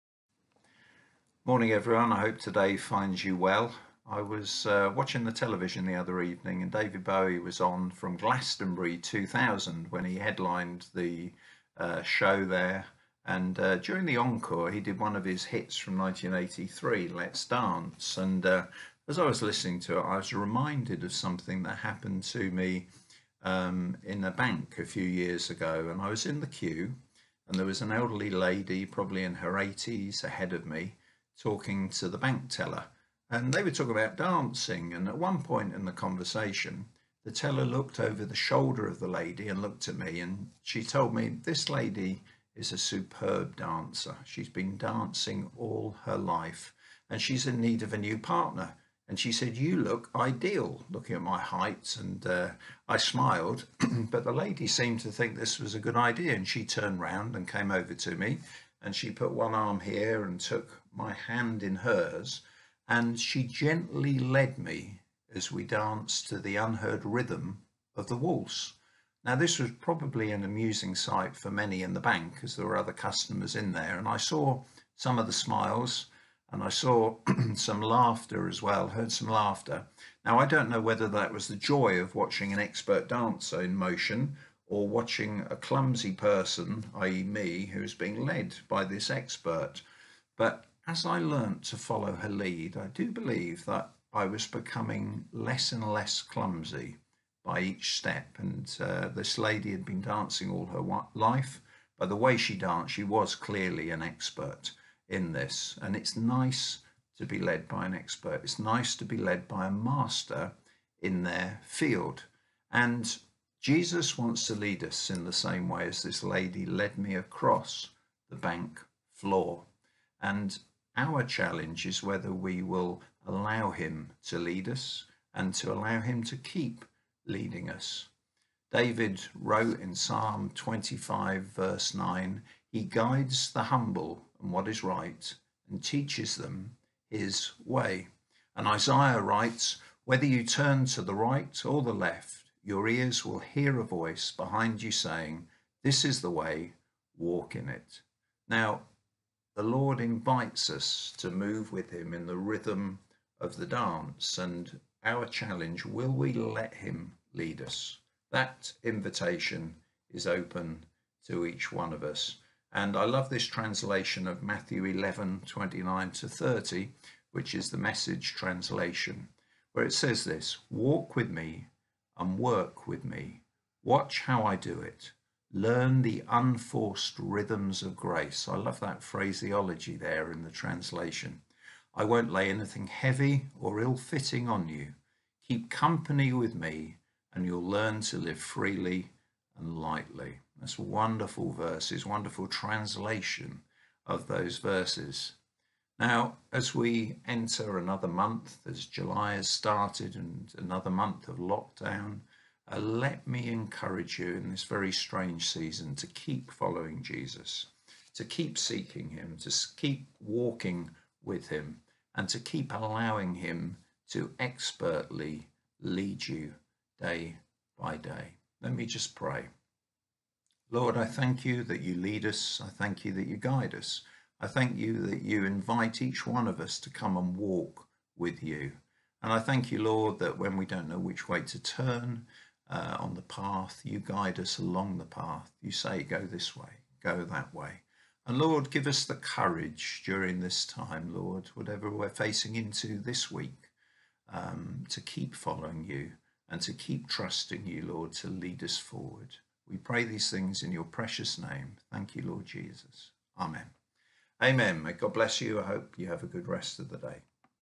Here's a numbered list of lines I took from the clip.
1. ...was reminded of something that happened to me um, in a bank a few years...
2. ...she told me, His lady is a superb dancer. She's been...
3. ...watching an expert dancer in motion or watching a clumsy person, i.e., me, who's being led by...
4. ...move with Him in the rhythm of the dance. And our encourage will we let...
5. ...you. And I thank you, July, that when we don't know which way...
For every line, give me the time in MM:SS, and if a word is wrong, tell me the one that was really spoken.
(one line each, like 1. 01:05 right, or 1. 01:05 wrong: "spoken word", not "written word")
1. 00:20 right
2. 00:40 wrong: "This", not "His"
3. 01:22 right
4. 02:31 wrong: "challenge", not "encourage"
5. 03:48 wrong: "Lord", not "July".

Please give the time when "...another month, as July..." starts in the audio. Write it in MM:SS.
03:17.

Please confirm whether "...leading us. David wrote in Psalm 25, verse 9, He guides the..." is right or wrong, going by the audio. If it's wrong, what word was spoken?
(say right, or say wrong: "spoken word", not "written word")
right.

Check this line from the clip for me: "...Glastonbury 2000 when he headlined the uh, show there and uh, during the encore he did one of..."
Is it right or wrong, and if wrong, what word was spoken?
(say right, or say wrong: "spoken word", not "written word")
right.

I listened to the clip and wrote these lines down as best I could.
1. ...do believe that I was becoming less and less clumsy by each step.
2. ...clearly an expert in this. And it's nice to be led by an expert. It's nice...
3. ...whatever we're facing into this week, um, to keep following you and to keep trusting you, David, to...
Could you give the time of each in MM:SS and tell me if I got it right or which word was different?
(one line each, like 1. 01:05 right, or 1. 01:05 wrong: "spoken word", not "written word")
1. 01:32 right
2. 01:43 right
3. 04:01 wrong: "Lord", not "David".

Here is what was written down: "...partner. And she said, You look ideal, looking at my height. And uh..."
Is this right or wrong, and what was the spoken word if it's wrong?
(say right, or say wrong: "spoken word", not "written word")
right.